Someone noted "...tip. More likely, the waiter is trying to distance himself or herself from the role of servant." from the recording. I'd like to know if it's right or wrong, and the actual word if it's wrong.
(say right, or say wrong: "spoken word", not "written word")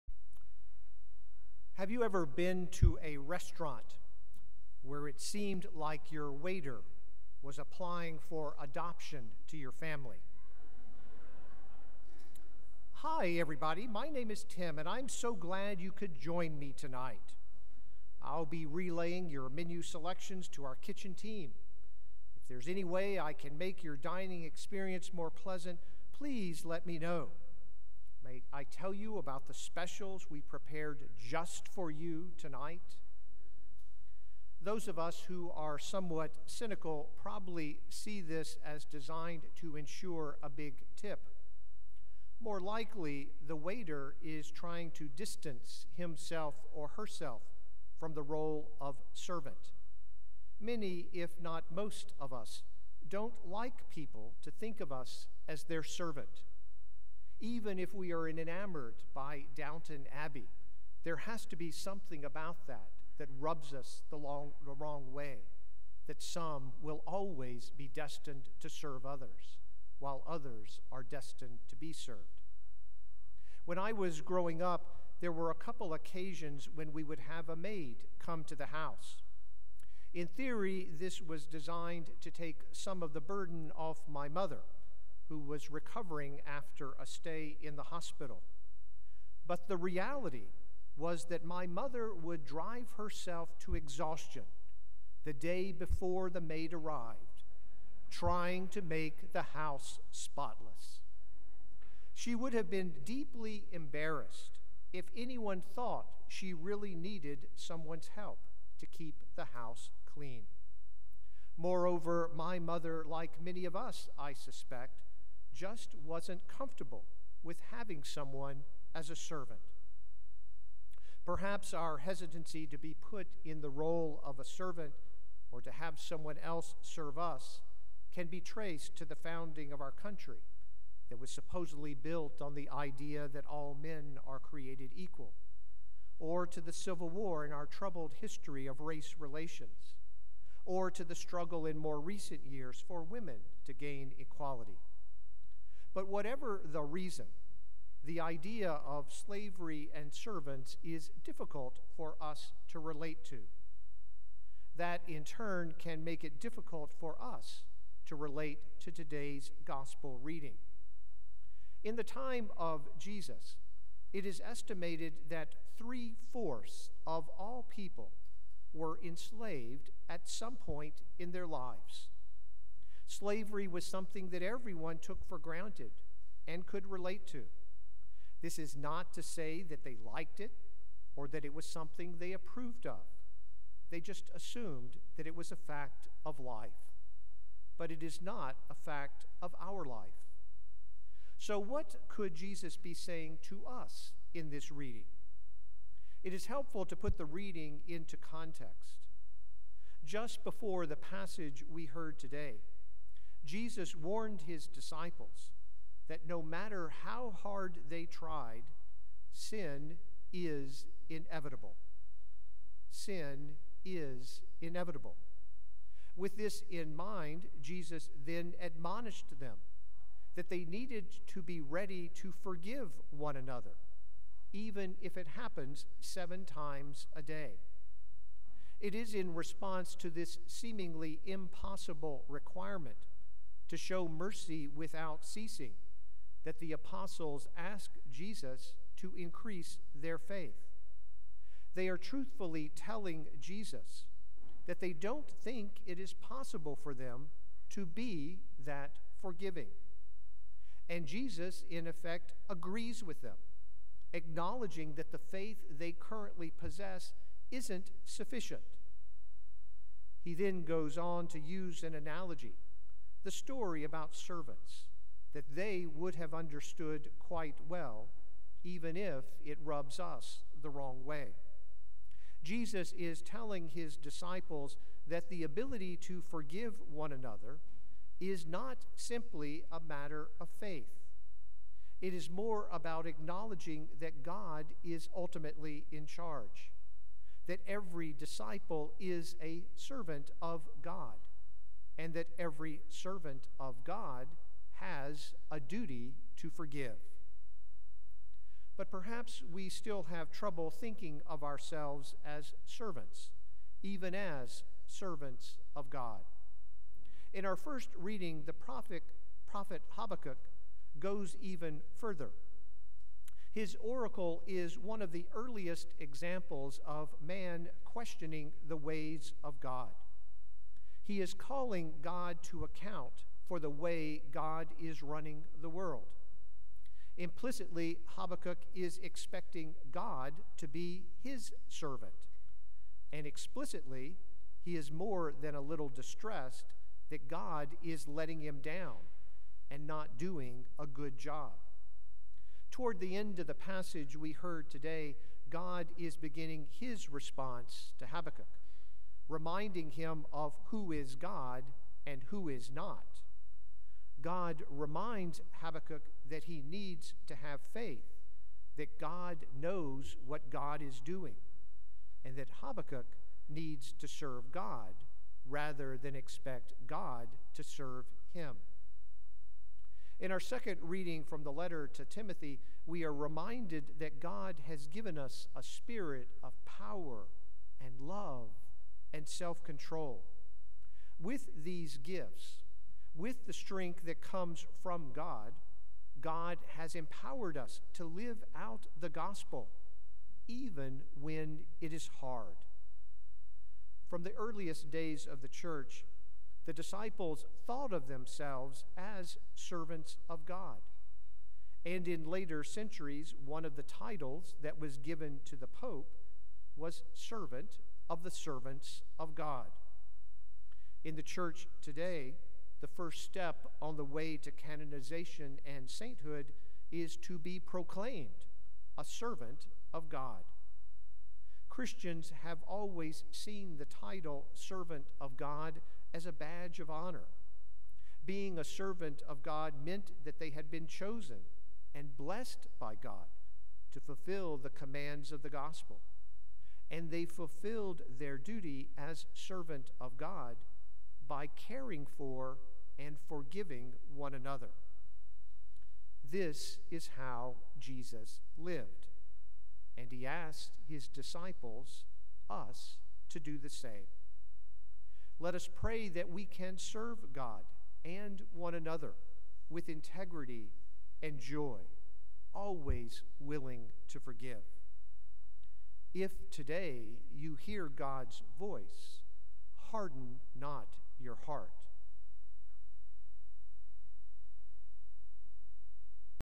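right.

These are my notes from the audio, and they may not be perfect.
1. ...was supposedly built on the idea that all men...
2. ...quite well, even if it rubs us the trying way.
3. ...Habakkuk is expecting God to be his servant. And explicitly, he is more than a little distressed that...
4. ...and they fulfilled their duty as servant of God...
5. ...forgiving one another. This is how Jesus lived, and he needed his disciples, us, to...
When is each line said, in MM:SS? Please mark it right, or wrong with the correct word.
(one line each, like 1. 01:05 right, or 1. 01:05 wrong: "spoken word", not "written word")
1. 02:11 right
2. 04:27 wrong: "wrong", not "trying"
3. 05:28 right
4. 07:16 right
5. 07:23 wrong: "asked", not "needed".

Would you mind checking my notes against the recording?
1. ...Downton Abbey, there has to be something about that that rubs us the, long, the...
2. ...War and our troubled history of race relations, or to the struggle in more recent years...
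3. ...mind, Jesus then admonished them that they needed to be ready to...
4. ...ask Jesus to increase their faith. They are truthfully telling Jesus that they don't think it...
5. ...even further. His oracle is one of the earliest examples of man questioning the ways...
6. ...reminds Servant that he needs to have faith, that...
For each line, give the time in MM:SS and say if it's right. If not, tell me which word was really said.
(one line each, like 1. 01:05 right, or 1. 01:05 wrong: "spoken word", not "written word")
1. 00:59 right
2. 02:17 right
3. 03:36 right
4. 03:57 right
5. 05:11 right
6. 05:54 wrong: "Habakkuk", not "Servant".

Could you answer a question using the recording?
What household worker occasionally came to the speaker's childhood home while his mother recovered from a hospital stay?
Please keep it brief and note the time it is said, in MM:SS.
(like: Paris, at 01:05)
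A maid, at 01:17.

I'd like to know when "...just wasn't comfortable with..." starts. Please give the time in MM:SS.
01:55.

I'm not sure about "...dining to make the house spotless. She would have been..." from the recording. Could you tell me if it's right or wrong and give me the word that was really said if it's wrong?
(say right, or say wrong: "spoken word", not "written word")
wrong: "trying", not "dining".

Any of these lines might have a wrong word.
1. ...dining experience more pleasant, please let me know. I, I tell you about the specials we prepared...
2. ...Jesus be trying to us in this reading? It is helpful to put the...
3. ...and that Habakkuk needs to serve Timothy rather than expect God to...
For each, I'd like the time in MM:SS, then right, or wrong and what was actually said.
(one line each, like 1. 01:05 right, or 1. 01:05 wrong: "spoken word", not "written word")
1. 00:23 right
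2. 03:12 wrong: "saying", not "trying"
3. 06:02 wrong: "God", not "Timothy".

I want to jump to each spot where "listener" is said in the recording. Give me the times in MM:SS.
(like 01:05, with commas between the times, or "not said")
not said.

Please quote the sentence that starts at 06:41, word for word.
And in later centuries, one of the titles that was given to the Pope was Servant of the servants of God.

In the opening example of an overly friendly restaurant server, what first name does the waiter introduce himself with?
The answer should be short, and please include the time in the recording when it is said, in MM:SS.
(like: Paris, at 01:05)
Tim, at 00:14.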